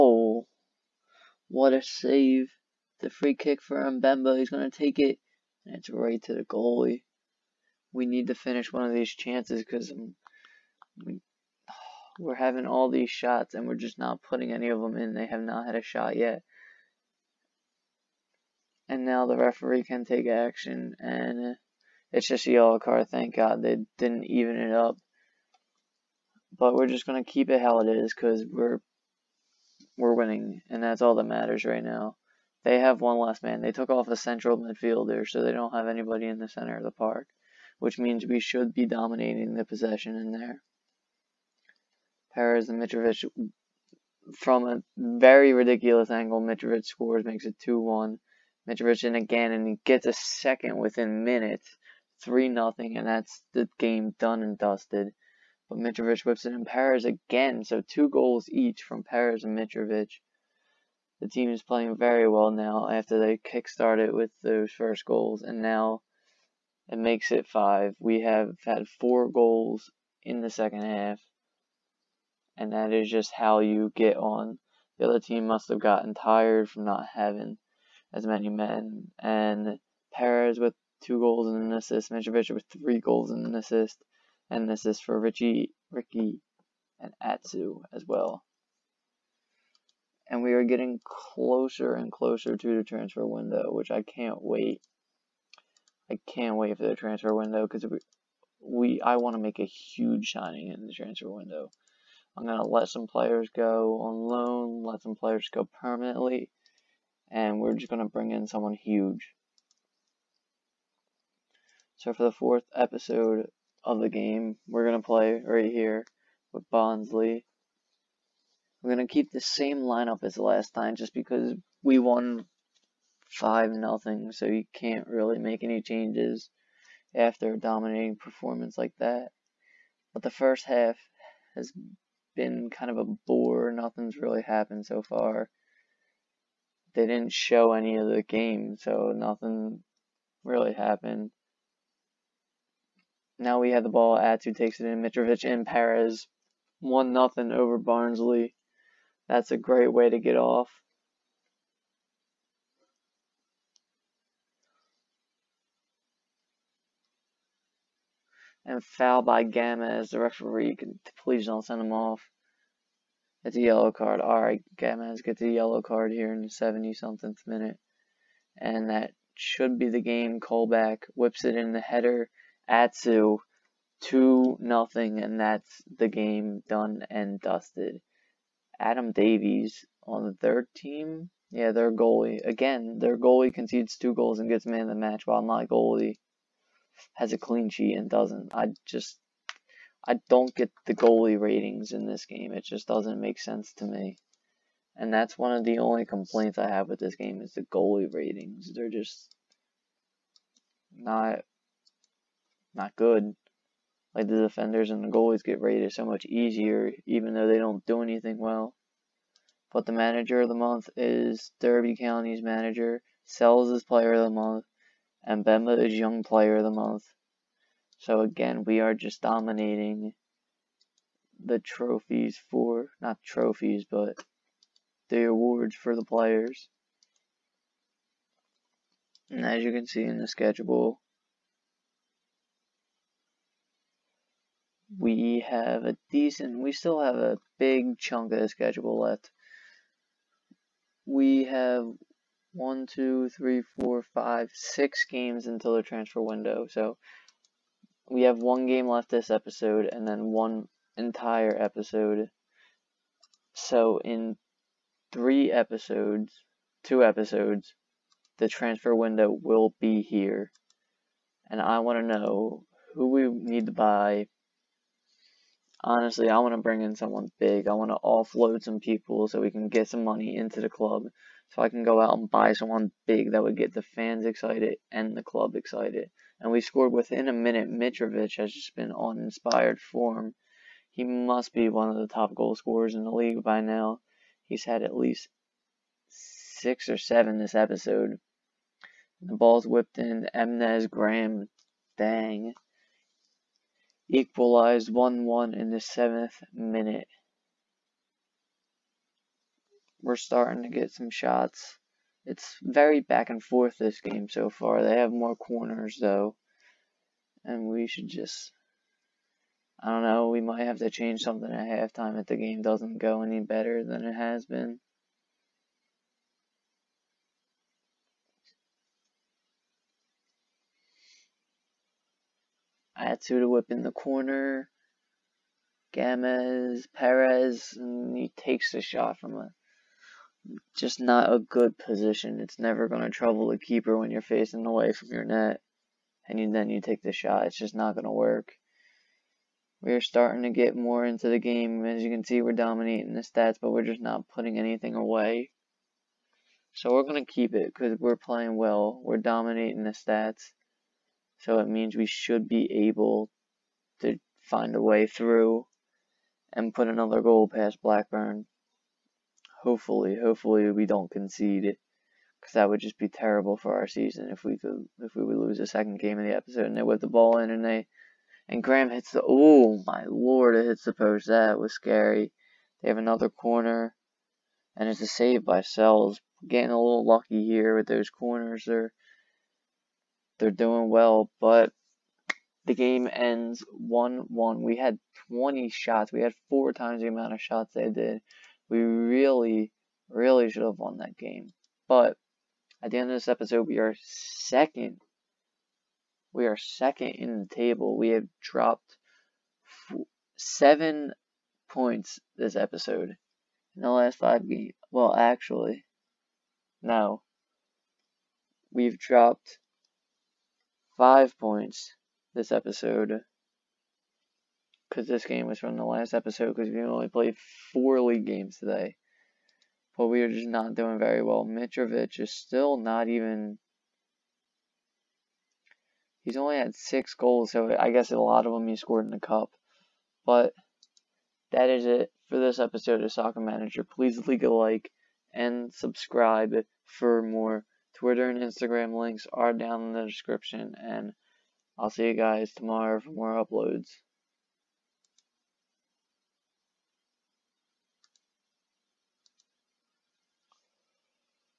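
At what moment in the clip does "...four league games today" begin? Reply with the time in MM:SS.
06:57.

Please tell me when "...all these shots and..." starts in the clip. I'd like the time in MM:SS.
00:12.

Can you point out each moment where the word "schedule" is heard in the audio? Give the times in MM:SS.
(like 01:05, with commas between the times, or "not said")
03:50, 03:58.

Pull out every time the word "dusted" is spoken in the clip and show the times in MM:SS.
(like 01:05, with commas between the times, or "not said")
00:54, 02:57.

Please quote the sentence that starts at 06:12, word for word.
They have another corner, and it's a save by Sels.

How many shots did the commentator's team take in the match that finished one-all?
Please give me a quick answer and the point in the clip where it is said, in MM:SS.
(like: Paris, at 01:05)
20, at 06:25.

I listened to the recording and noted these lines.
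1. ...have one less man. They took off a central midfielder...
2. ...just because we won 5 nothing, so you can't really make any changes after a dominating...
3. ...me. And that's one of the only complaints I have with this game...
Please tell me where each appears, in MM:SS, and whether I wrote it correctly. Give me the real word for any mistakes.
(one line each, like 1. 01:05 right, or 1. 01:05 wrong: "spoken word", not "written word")
1. 00:32 right
2. 02:00 right
3. 03:13 right.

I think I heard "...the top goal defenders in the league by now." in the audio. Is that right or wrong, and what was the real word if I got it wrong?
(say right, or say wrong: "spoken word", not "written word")
wrong: "scorers", not "defenders".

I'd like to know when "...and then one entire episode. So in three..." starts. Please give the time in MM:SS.
04:09.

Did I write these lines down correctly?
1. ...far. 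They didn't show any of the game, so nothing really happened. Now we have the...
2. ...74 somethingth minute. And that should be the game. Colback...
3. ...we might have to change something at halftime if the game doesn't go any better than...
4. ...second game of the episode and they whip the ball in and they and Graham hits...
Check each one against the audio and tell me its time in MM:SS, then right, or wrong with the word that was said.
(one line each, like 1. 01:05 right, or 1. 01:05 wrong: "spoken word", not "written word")
1. 02:15 right
2. 02:46 wrong: "70", not "74"
3. 05:10 right
4. 06:05 right.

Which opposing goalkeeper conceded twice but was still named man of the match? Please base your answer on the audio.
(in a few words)
Adam Davies.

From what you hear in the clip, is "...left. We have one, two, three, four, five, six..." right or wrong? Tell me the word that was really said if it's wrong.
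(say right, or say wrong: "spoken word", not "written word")
right.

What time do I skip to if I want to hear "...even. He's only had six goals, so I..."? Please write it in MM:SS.
07:03.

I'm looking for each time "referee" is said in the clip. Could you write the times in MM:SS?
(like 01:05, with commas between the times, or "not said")
00:19, 02:40.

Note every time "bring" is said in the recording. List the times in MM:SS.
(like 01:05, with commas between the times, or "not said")
01:48, 04:26.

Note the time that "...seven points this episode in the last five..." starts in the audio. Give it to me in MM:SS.
06:40.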